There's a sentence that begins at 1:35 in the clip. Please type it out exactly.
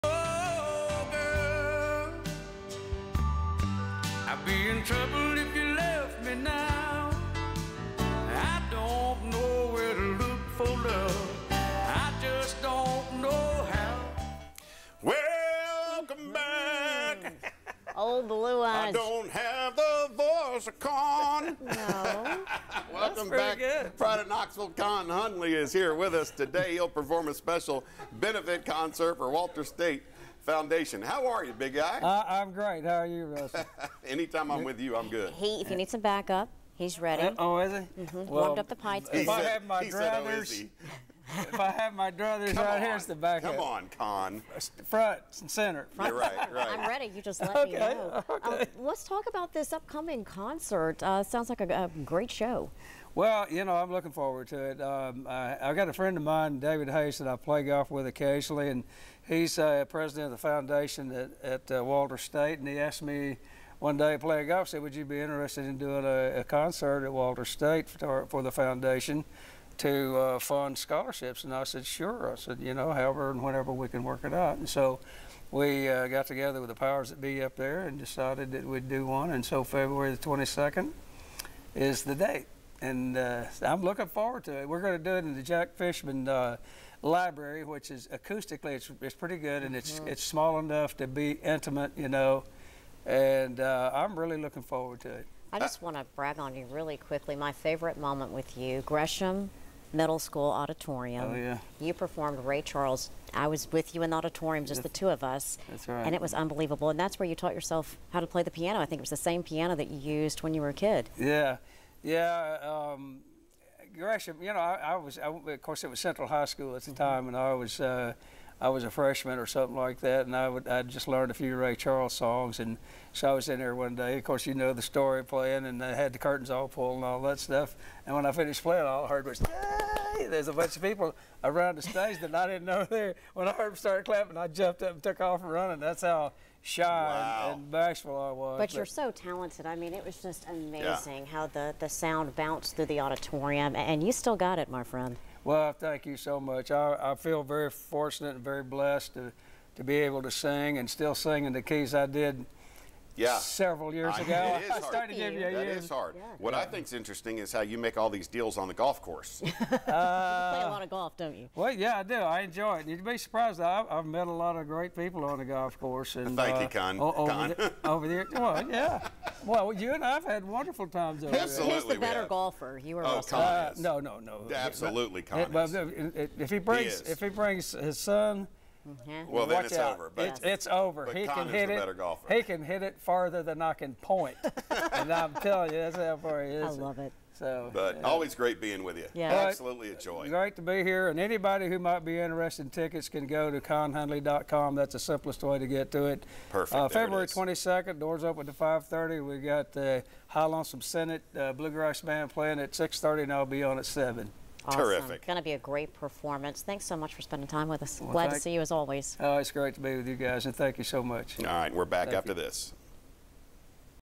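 I just want to brag on you really quickly.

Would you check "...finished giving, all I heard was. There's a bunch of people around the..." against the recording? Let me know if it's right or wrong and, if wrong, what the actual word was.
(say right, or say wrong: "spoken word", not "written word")
wrong: "playing", not "giving".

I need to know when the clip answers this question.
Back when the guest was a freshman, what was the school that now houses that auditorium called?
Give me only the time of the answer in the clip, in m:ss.
1:55.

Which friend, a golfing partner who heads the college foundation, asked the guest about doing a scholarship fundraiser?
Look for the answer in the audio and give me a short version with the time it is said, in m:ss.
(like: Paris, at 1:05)
David Hayes, at 0:56.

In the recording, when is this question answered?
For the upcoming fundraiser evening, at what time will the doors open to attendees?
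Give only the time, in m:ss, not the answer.
3:18.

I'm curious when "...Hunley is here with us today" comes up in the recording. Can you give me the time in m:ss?
0:25.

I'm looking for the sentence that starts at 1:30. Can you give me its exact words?
it's small enough to be intimate, you know.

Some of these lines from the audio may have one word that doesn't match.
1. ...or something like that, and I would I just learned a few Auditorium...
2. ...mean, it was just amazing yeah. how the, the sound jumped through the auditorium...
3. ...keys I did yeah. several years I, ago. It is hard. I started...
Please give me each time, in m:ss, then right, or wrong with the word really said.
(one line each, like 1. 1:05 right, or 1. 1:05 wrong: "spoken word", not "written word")
1. 1:59 wrong: "Ray", not "Auditorium"
2. 2:19 wrong: "bounced", not "jumped"
3. 2:31 right.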